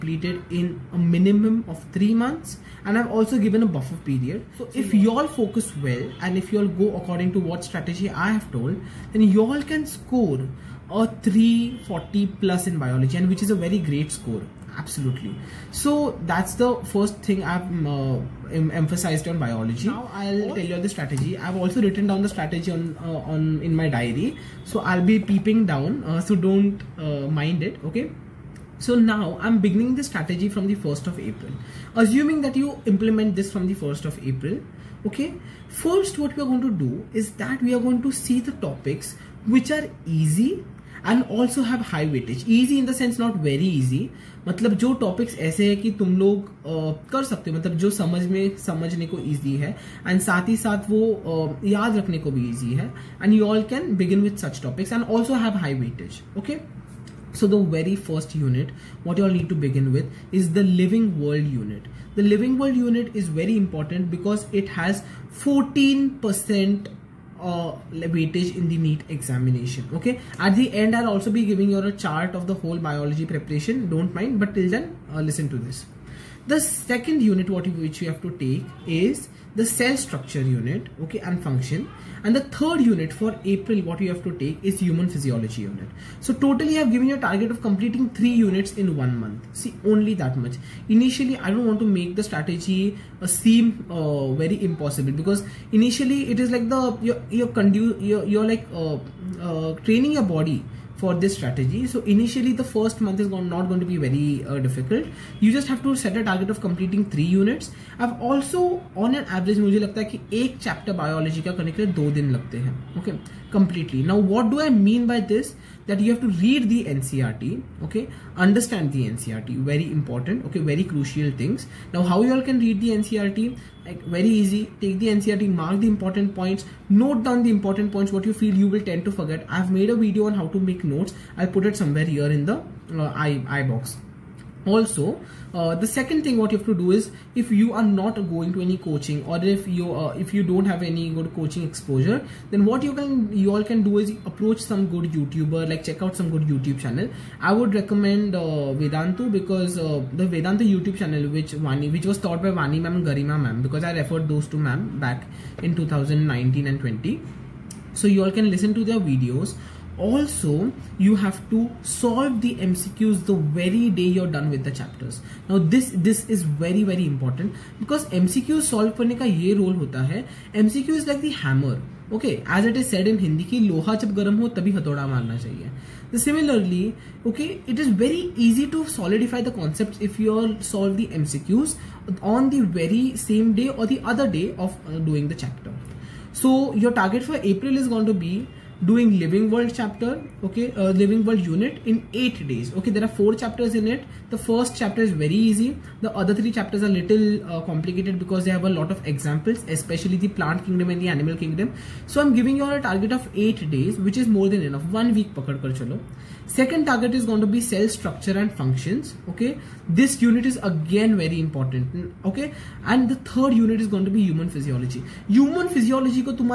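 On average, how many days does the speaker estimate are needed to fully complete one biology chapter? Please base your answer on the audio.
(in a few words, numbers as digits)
2 days.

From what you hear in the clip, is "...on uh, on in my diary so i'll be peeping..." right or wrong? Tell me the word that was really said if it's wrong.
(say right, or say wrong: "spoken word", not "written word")
right.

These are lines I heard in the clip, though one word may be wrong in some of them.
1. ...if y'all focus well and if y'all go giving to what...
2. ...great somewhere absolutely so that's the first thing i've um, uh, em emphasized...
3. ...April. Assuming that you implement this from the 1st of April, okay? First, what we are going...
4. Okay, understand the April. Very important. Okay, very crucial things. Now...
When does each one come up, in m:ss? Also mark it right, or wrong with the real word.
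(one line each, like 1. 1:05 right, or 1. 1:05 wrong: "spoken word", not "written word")
1. 0:04 wrong: "according", not "giving"
2. 0:13 wrong: "score", not "somewhere"
3. 0:31 right
4. 1:57 wrong: "NCRT", not "April".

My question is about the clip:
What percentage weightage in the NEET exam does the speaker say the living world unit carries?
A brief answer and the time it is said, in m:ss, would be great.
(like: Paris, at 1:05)
14%, at 1:05.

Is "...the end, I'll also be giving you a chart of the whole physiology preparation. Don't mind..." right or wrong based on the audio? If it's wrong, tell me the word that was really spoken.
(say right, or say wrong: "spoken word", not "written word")
wrong: "biology", not "physiology".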